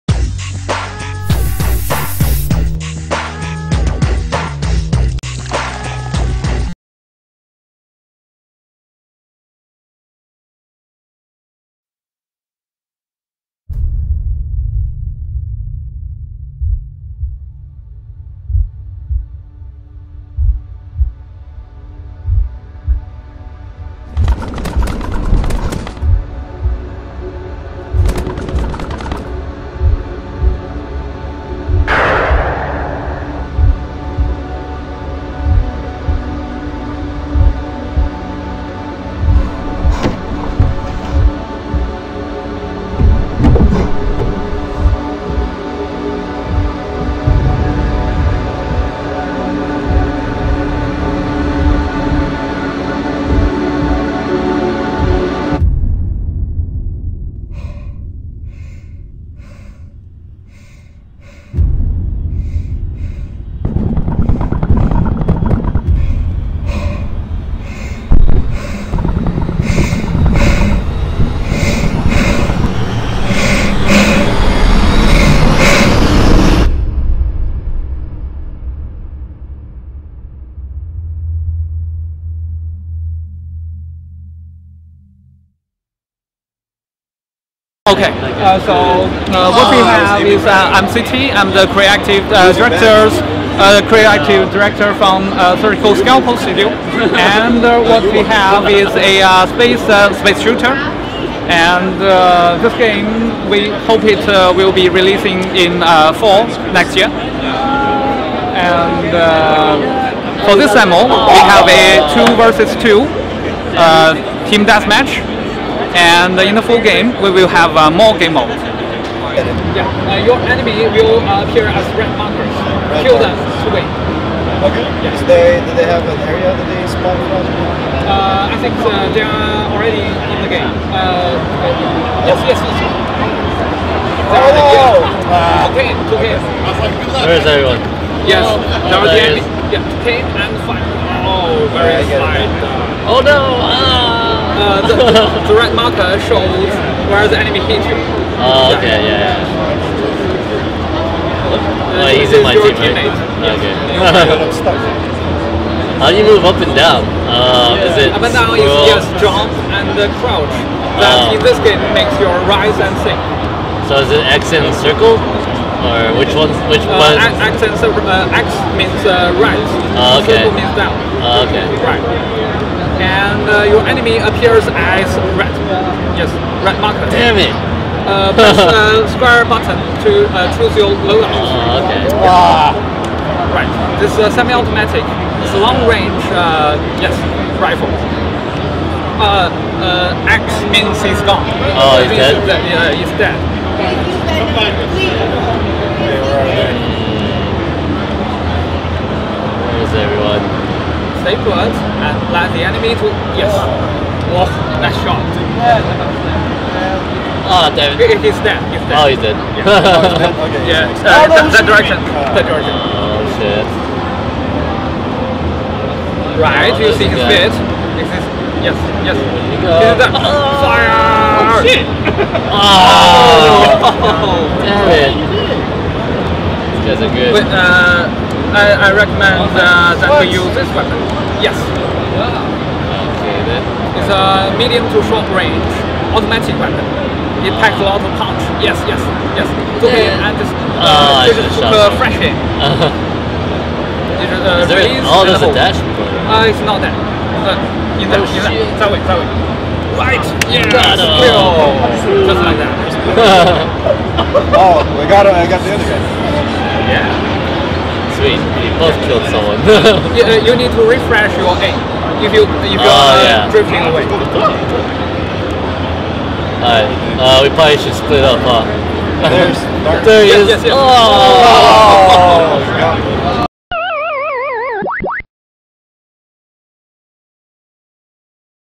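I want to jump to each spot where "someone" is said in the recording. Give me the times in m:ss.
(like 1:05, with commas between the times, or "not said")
4:19.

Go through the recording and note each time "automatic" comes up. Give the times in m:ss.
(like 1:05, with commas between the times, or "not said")
3:04, 3:56.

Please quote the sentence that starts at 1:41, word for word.
And this game, we hope it will be releasing in fall next year.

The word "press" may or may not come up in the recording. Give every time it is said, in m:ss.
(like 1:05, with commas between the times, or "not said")
2:58.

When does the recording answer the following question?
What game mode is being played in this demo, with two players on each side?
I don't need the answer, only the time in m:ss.
1:54.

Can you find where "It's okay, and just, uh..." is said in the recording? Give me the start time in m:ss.
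3:59.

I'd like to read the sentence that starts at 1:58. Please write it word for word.
Yeah, uh, your enemy will appear as red markers.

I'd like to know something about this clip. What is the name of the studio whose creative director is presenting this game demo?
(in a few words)
Surgical Scalpel Studio.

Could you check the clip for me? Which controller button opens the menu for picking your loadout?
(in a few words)
Square.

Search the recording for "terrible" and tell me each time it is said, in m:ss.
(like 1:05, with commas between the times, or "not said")
not said.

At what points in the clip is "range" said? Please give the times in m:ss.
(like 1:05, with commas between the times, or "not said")
3:05, 3:55.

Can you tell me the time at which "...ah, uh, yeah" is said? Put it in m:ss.
4:22.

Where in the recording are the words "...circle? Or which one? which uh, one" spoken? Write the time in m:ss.
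2:44.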